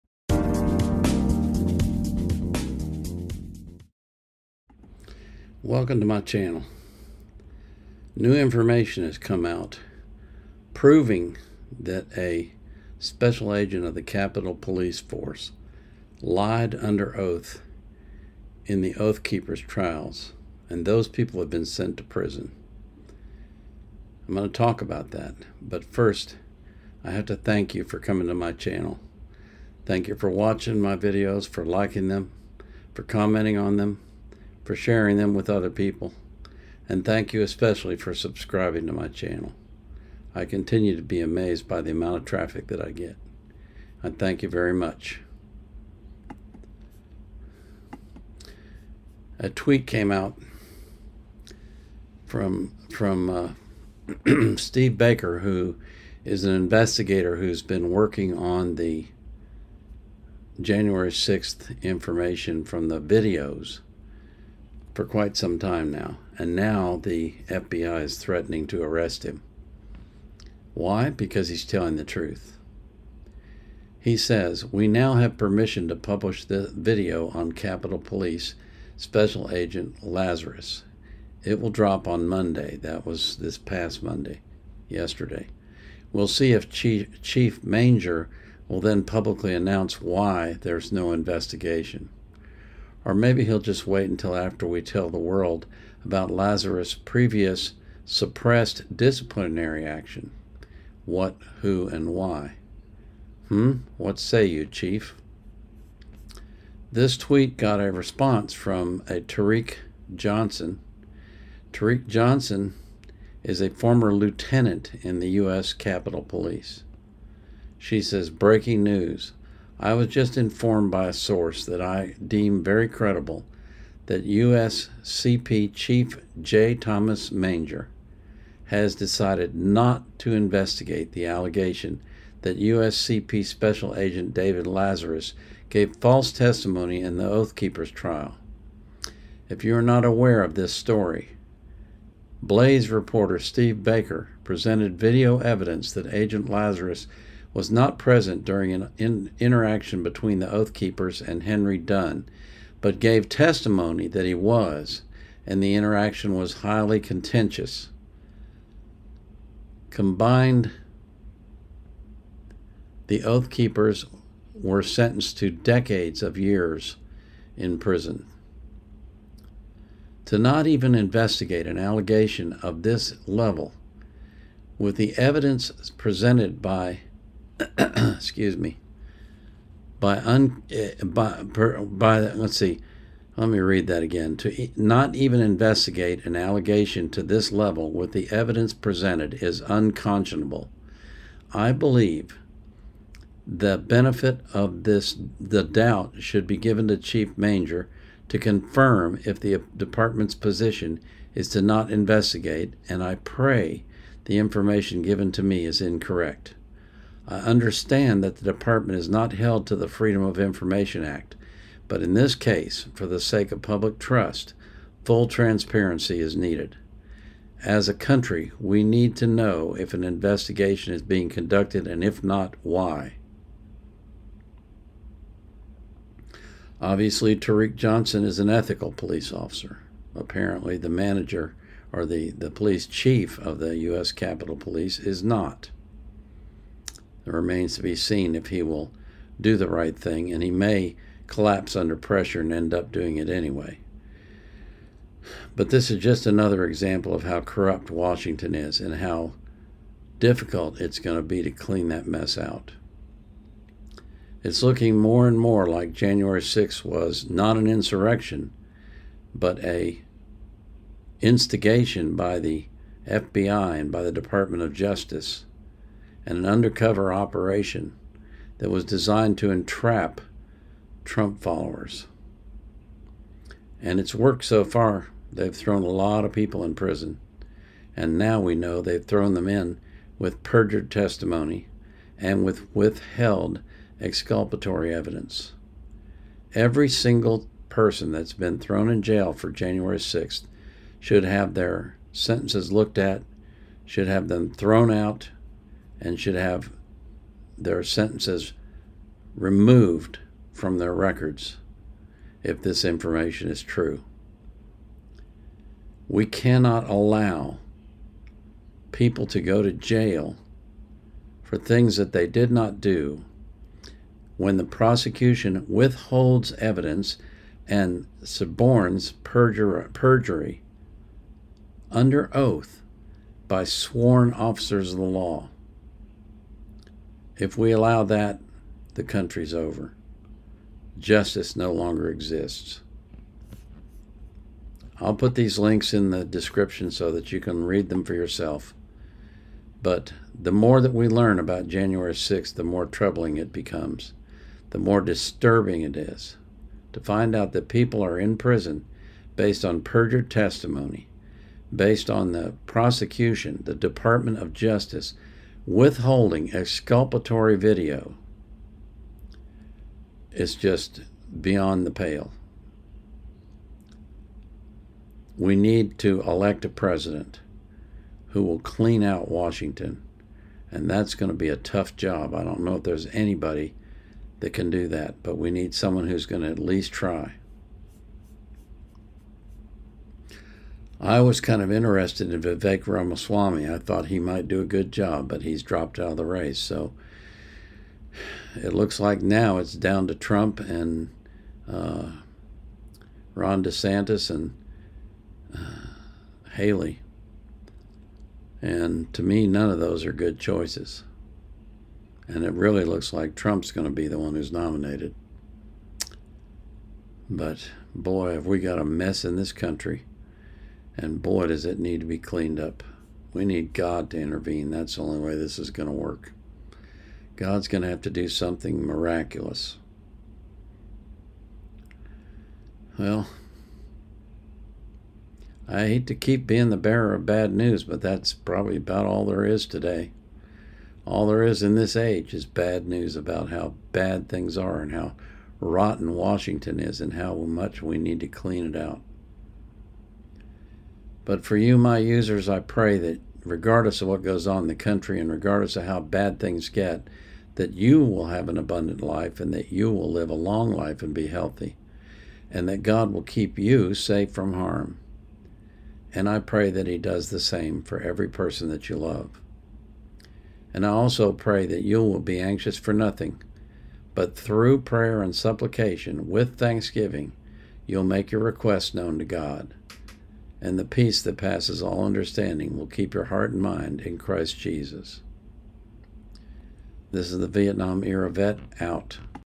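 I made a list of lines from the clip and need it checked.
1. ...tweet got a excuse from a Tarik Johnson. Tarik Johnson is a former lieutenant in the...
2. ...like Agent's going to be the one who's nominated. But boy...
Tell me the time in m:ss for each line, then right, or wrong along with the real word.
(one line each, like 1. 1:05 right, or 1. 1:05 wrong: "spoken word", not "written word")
1. 1:47 wrong: "response", not "excuse"
2. 6:43 wrong: "Trump", not "Agent".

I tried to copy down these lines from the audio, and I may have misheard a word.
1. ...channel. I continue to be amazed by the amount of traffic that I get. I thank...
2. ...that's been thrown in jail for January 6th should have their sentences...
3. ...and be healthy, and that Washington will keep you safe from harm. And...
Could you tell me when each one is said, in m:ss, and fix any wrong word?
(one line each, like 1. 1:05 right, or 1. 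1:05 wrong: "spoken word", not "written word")
1. 0:39 right
2. 4:48 right
3. 7:31 wrong: "God", not "Washington".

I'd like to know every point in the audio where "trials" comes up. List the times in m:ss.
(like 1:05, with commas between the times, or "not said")
0:19, 2:17.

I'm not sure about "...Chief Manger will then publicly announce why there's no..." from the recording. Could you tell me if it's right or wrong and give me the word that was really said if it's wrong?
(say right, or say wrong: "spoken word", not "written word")
right.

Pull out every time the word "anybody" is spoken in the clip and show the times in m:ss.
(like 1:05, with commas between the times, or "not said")
6:13.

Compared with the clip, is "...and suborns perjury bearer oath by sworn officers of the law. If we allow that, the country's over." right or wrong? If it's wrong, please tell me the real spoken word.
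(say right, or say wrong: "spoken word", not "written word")
wrong: "under", not "bearer".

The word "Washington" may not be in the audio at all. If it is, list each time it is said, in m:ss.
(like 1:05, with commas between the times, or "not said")
4:07, 6:09, 7:16.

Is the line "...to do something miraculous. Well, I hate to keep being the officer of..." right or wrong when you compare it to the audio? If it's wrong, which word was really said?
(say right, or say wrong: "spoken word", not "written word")
wrong: "bearer", not "officer".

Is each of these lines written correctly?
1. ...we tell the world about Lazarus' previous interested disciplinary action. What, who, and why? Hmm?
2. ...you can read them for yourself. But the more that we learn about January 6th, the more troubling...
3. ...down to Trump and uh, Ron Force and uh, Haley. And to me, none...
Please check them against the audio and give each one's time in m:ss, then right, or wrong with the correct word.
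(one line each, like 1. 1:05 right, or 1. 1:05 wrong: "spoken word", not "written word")
1. 1:34 wrong: "suppressed", not "interested"
2. 5:37 right
3. 6:29 wrong: "DeSantis", not "Force".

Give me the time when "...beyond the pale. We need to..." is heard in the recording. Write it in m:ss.
6:01.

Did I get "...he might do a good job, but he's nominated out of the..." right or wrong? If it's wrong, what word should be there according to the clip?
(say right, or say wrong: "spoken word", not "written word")
wrong: "dropped", not "nominated".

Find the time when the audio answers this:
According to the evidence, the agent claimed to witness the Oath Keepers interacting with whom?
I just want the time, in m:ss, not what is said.
2:31.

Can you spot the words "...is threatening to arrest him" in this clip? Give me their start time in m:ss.
1:08.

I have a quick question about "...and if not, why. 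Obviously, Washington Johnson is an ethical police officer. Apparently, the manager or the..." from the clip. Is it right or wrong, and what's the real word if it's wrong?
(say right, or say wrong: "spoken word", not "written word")
wrong: "Tarik", not "Washington".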